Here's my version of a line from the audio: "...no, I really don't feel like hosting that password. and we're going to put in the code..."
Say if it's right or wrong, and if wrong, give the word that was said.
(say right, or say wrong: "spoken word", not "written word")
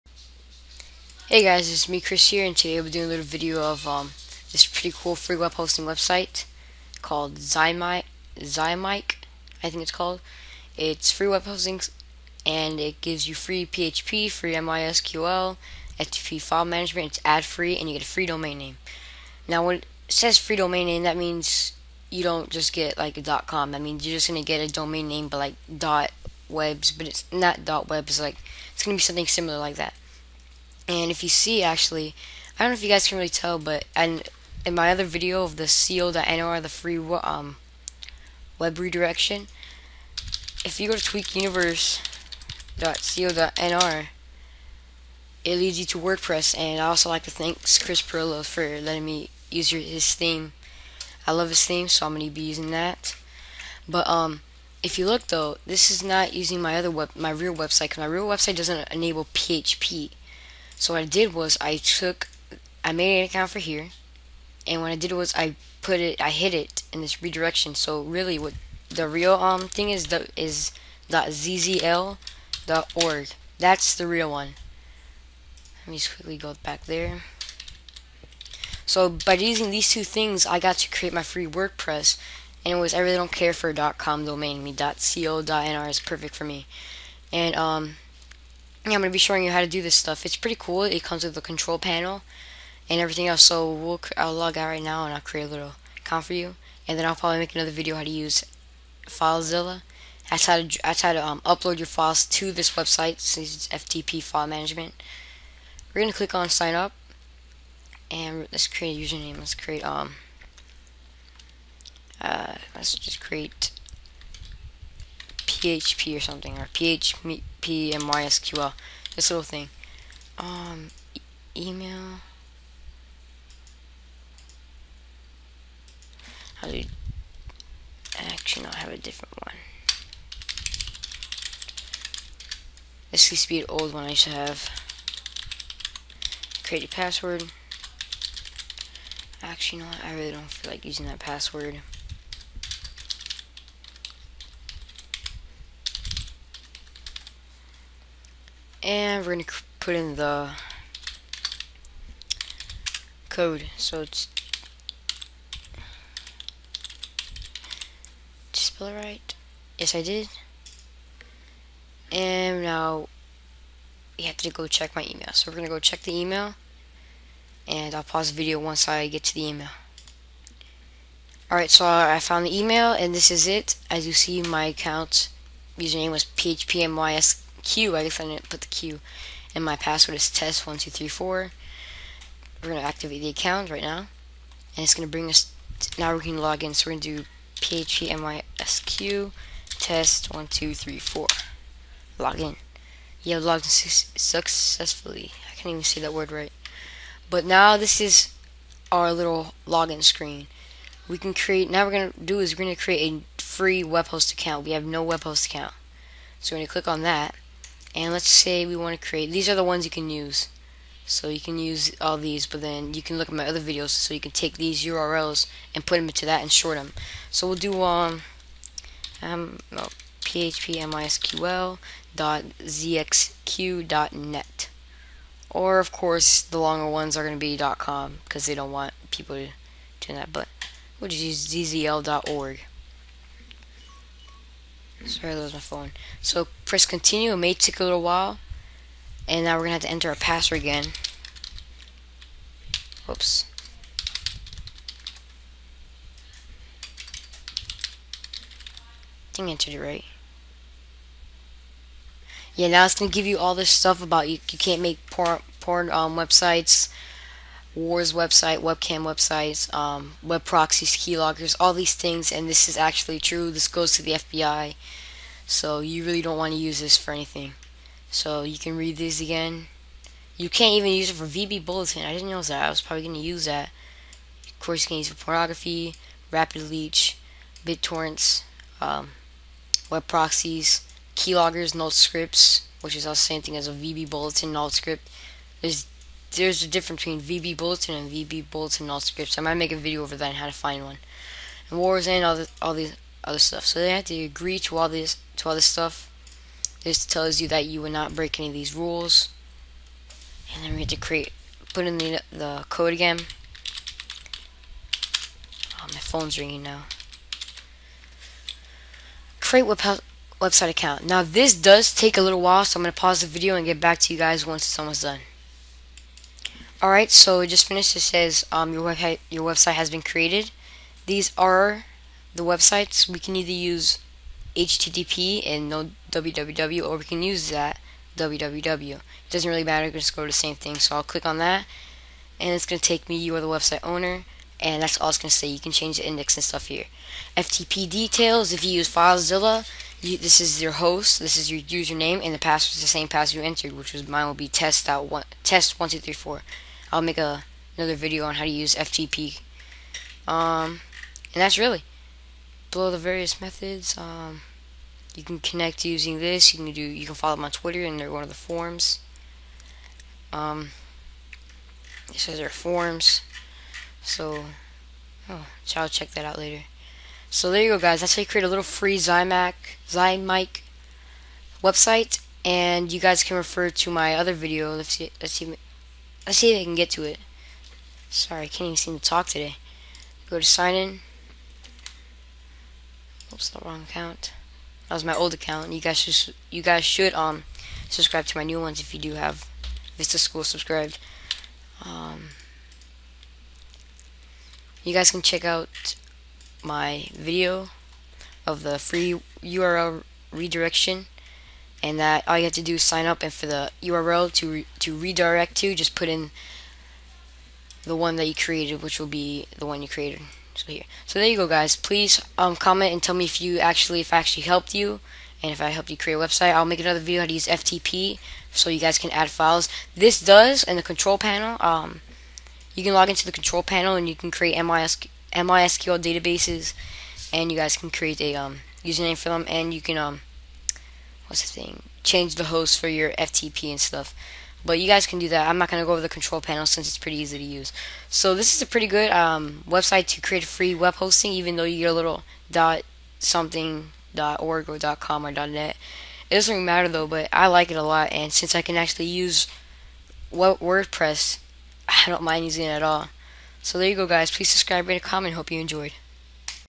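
wrong: "using", not "hosting".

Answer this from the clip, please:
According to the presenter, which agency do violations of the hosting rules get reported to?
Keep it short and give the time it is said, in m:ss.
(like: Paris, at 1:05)
FBI, at 4:24.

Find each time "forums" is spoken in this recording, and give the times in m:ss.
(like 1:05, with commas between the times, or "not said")
5:58, 6:02.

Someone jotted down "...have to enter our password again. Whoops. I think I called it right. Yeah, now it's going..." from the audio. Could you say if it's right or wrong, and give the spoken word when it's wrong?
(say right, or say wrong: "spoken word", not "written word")
wrong: "entered", not "called".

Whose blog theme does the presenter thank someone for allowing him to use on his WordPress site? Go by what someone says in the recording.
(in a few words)
Chris Pirillo.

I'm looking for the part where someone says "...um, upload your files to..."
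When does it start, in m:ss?
1:41.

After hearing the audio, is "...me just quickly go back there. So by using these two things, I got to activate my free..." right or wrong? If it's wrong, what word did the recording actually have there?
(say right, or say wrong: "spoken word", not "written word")
wrong: "create", not "activate".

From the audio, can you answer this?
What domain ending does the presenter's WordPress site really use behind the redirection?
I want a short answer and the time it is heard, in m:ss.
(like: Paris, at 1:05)
zzl.org, at 1:11.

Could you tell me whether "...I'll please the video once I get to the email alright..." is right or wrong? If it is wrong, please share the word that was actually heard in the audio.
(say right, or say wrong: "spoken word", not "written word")
wrong: "pause", not "please".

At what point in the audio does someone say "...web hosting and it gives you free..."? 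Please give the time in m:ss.
0:11.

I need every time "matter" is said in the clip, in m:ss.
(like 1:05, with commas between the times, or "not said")
5:29, 7:26.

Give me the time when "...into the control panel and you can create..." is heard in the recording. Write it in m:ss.
7:03.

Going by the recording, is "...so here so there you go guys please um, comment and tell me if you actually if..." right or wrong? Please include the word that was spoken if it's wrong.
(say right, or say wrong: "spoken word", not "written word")
right.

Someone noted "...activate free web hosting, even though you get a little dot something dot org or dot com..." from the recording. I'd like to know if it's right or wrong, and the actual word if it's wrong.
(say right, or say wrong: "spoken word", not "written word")
wrong: "create", not "activate".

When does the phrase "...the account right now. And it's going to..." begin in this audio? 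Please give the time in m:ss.
3:03.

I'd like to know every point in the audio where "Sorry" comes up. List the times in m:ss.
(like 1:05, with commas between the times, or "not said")
3:55, 6:18.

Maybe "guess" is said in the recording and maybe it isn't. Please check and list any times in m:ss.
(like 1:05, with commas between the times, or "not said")
2:58.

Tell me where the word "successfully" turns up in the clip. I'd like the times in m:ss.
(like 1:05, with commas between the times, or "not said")
3:14.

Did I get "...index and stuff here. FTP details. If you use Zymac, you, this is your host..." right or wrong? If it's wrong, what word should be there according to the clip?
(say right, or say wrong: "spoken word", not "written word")
wrong: "FileZilla", not "Zymac".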